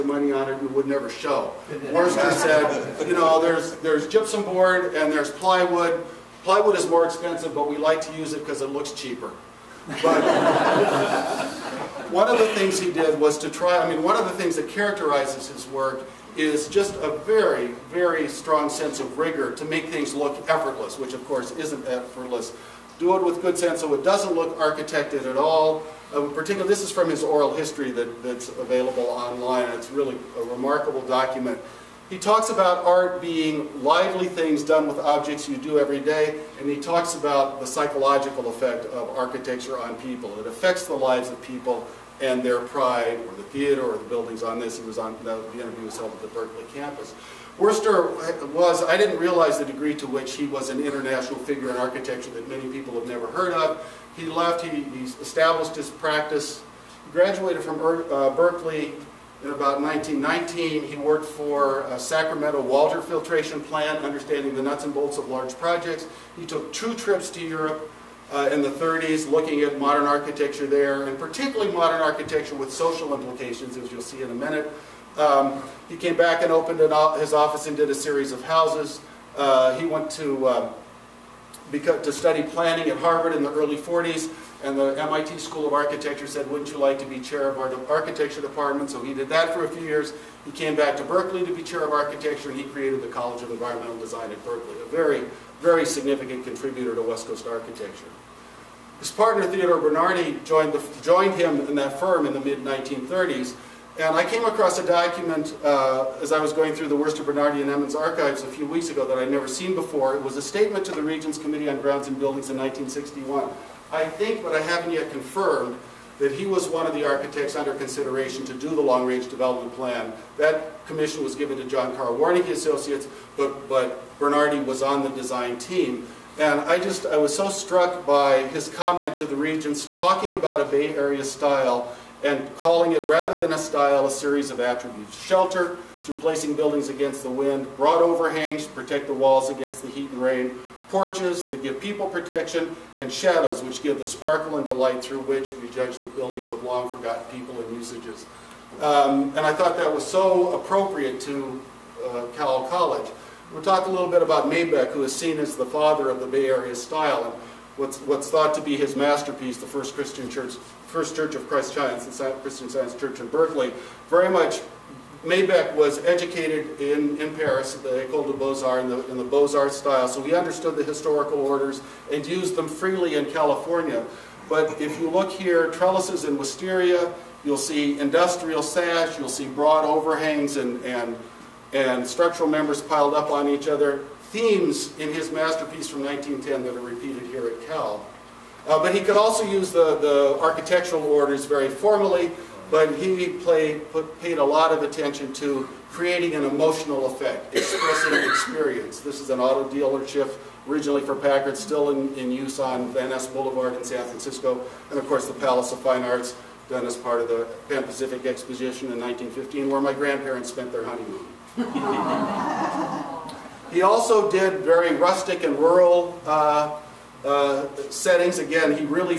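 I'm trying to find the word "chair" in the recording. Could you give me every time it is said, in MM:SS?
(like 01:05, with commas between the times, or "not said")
01:27, 01:31.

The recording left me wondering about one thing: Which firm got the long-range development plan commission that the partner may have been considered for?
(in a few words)
John Carl Warnecke Associates.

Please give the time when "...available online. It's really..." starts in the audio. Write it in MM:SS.
00:28.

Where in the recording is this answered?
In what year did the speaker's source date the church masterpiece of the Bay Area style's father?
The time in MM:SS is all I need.
03:06.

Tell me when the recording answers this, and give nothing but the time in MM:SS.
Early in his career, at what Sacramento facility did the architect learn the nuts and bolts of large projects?
01:01.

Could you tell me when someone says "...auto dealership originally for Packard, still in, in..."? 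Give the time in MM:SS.
03:19.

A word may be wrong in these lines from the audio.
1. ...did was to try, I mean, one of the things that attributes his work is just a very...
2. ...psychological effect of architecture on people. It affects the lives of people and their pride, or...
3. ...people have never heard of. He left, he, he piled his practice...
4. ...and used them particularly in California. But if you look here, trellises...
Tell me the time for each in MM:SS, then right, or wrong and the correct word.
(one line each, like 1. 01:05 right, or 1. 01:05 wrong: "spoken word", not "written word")
1. 00:12 wrong: "characterizes", not "attributes"
2. 00:37 right
3. 00:52 wrong: "established", not "piled"
4. 02:52 wrong: "freely", not "particularly".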